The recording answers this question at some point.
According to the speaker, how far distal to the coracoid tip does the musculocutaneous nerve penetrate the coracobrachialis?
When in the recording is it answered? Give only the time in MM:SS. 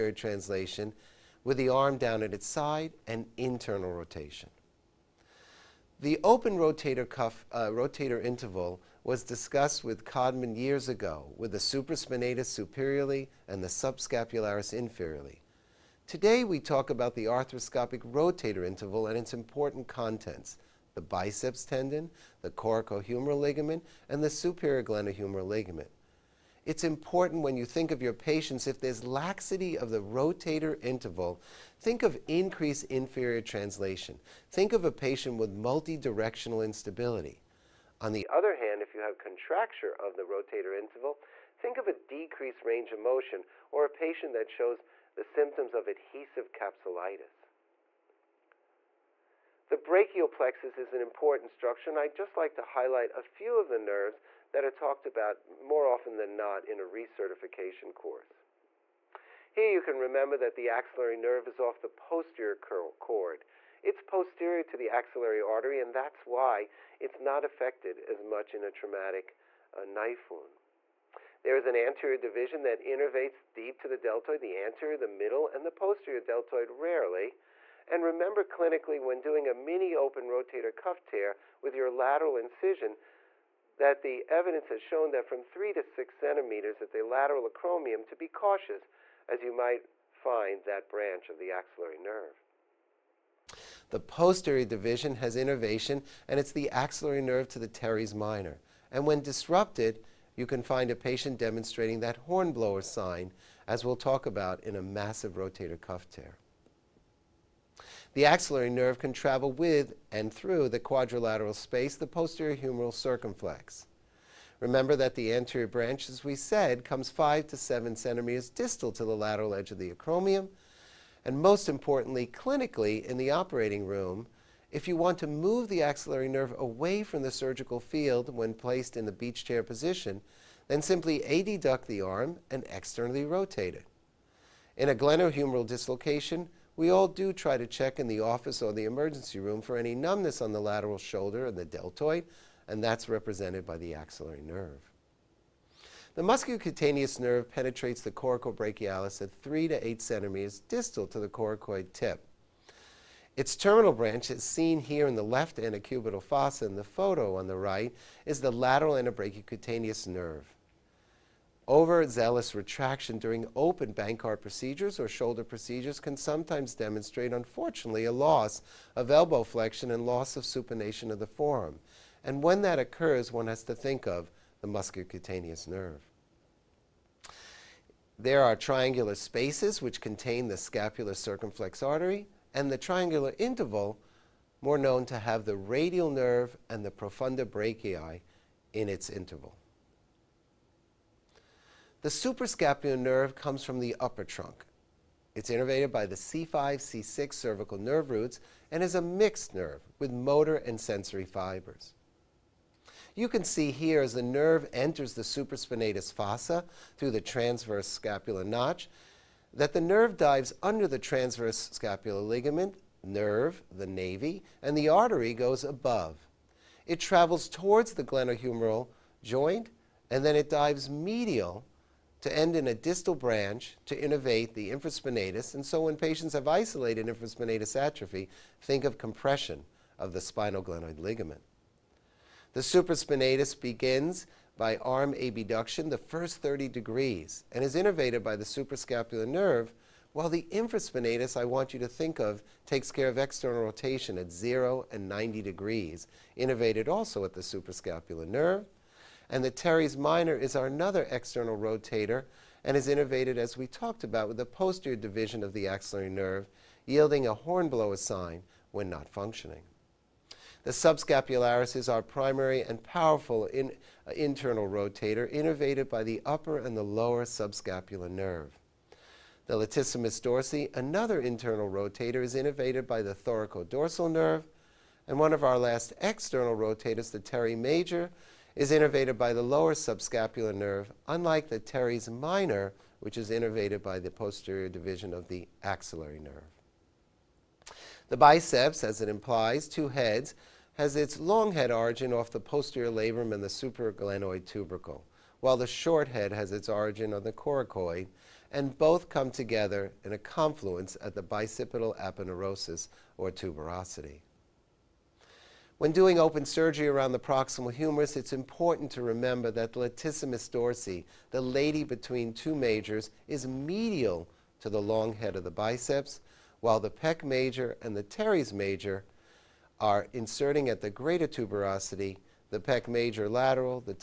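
02:29.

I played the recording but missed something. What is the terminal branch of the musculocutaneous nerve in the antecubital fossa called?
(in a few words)
lateral antebrachiocutaneous nerve.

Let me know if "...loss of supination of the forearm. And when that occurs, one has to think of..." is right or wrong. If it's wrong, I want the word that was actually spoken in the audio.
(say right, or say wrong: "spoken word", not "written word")
right.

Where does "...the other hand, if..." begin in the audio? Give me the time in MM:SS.
00:38.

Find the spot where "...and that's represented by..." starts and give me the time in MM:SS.
02:22.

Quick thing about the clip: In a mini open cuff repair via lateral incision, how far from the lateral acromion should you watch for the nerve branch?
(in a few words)
3 to 6 centimeters.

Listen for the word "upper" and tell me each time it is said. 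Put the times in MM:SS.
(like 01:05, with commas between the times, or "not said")
03:13, 04:26.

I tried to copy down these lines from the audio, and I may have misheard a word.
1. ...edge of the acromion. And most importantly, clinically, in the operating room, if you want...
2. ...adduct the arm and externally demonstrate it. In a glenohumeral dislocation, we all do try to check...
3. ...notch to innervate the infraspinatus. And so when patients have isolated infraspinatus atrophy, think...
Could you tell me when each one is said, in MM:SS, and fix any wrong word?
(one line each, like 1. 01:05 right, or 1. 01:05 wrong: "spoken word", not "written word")
1. 01:59 right
2. 02:11 wrong: "rotate", not "demonstrate"
3. 03:43 wrong: "branch", not "notch".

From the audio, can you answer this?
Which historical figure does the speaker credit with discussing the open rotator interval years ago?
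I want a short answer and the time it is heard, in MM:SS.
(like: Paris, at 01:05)
Codman, at 00:10.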